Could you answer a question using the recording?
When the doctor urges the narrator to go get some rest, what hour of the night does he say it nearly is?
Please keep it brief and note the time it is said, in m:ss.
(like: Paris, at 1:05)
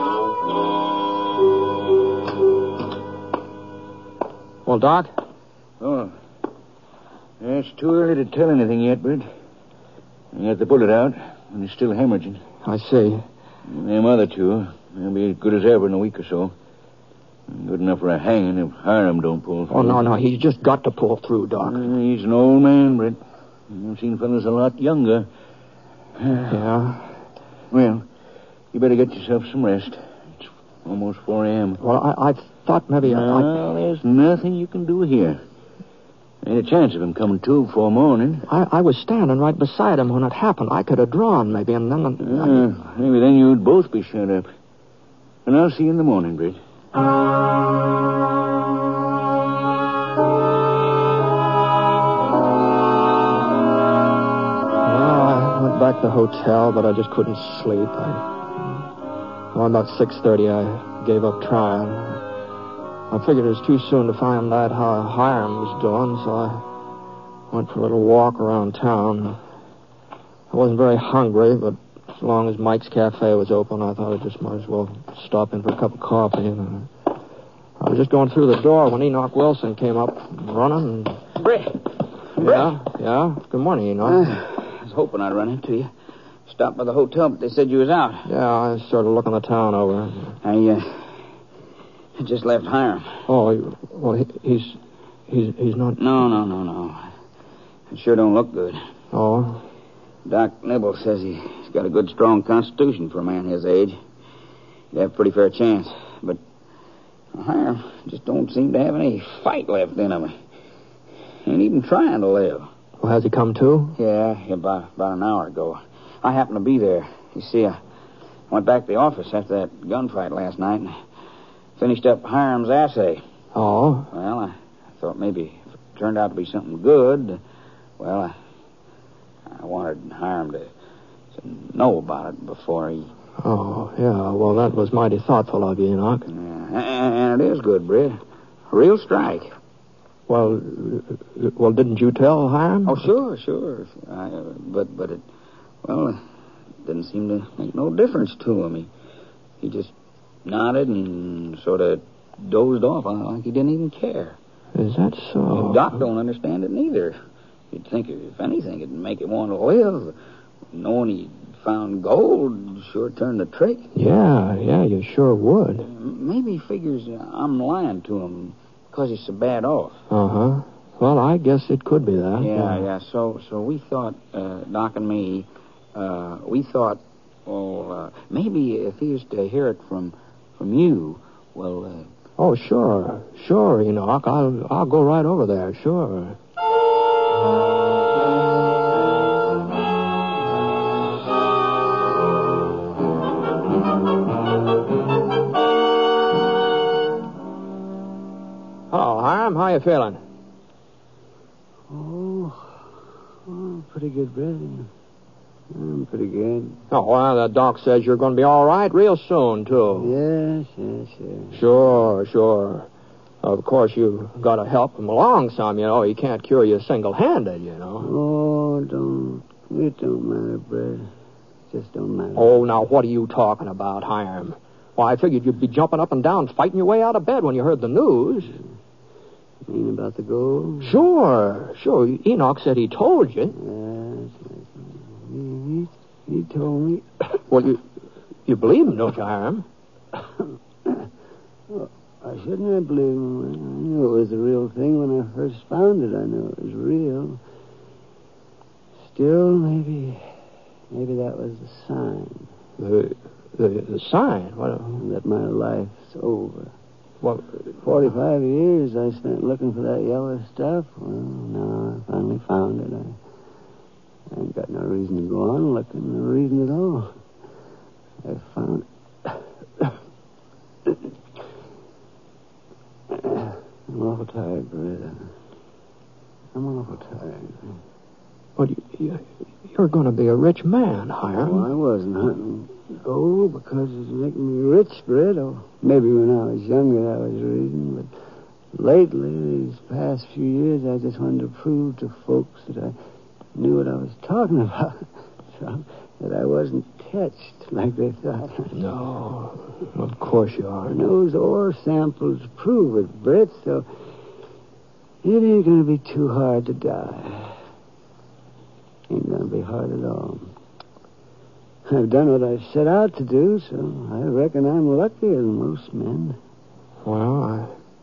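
4 a.m., at 0:31.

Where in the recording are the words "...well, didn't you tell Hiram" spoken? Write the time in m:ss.
2:21.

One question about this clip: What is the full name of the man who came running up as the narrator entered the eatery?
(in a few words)
Enoch Wilson.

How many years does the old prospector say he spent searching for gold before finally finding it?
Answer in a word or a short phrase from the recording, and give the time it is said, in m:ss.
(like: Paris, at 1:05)
45, at 4:17.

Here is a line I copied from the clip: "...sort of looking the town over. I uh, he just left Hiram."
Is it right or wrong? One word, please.
right.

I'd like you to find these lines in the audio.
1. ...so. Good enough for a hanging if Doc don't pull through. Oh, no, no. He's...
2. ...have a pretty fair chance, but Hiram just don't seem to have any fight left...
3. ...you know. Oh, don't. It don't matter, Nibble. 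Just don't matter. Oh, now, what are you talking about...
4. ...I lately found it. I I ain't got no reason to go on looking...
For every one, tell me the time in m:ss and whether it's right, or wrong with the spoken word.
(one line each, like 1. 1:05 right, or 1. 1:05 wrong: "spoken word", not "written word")
1. 0:16 wrong: "Hiram", not "Doc"
2. 1:45 right
3. 3:37 wrong: "Britt", not "Nibble"
4. 4:21 wrong: "finally", not "lately".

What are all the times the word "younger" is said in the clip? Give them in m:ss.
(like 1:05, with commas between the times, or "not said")
0:24, 4:46.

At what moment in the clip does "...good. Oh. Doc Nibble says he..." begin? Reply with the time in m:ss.
1:38.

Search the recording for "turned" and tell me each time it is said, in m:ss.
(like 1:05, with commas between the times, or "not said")
2:05, 2:43.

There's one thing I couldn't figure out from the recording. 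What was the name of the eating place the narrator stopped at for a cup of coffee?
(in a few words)
Mike's Cafe.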